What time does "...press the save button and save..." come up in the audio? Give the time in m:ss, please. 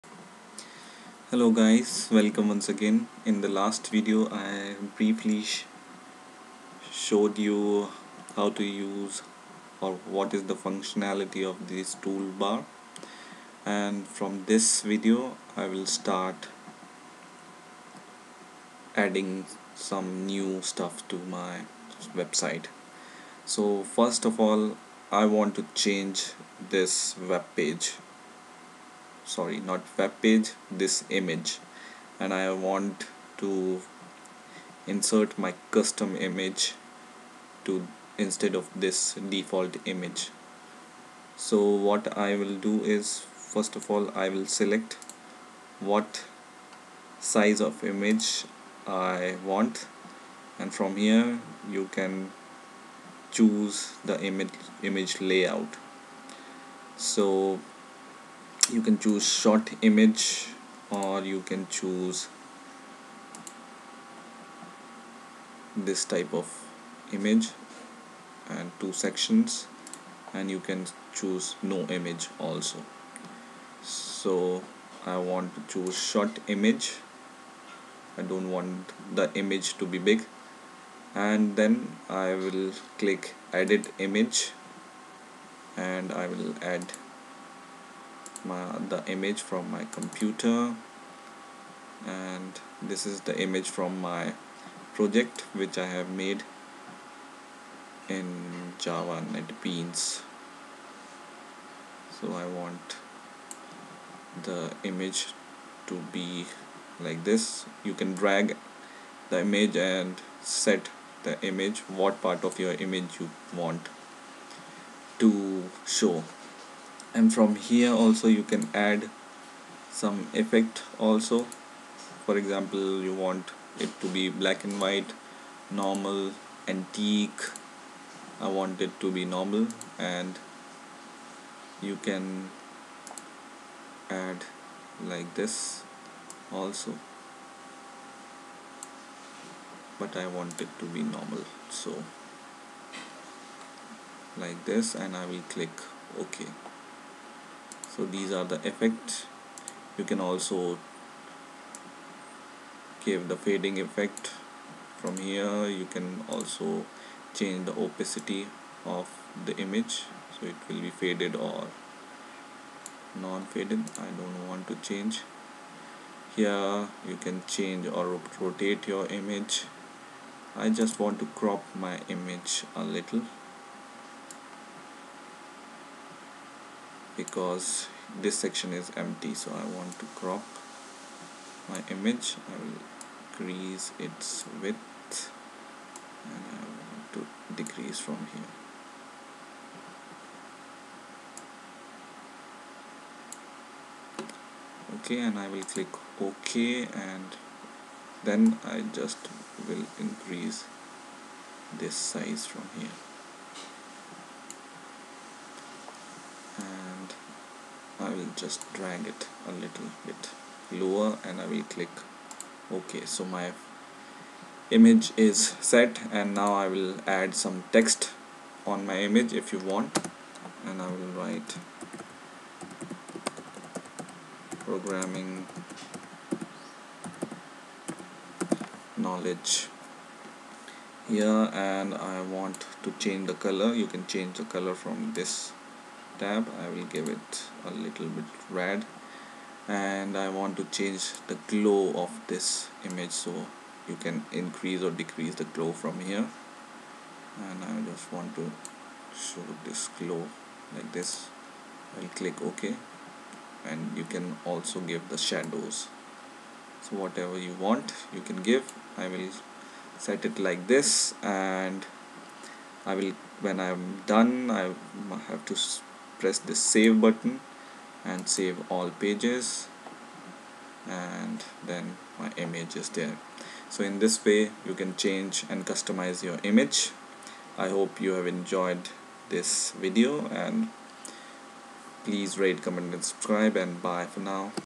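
4:26.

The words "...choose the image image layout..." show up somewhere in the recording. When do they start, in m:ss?
0:53.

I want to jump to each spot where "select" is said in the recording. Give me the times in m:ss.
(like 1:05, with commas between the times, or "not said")
0:44.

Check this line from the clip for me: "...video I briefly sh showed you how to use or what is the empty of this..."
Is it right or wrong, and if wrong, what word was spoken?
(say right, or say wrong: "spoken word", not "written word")
wrong: "functionality", not "empty".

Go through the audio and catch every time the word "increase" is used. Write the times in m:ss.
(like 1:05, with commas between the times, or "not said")
3:03, 3:19, 4:04.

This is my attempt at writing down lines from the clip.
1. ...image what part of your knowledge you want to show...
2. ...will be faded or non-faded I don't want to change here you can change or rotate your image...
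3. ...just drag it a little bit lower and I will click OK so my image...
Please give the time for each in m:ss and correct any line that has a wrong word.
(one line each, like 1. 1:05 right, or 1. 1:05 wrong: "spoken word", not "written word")
1. 1:51 wrong: "image", not "knowledge"
2. 2:40 right
3. 3:28 right.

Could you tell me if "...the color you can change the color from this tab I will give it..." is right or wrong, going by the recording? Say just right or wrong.
right.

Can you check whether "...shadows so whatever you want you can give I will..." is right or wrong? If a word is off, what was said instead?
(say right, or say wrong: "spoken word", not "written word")
right.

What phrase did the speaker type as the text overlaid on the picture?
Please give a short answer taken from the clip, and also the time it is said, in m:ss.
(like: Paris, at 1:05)
programming knowledge, at 3:44.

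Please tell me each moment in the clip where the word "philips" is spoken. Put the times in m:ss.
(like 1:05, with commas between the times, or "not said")
not said.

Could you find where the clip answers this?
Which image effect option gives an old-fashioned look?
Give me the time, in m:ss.
2:06.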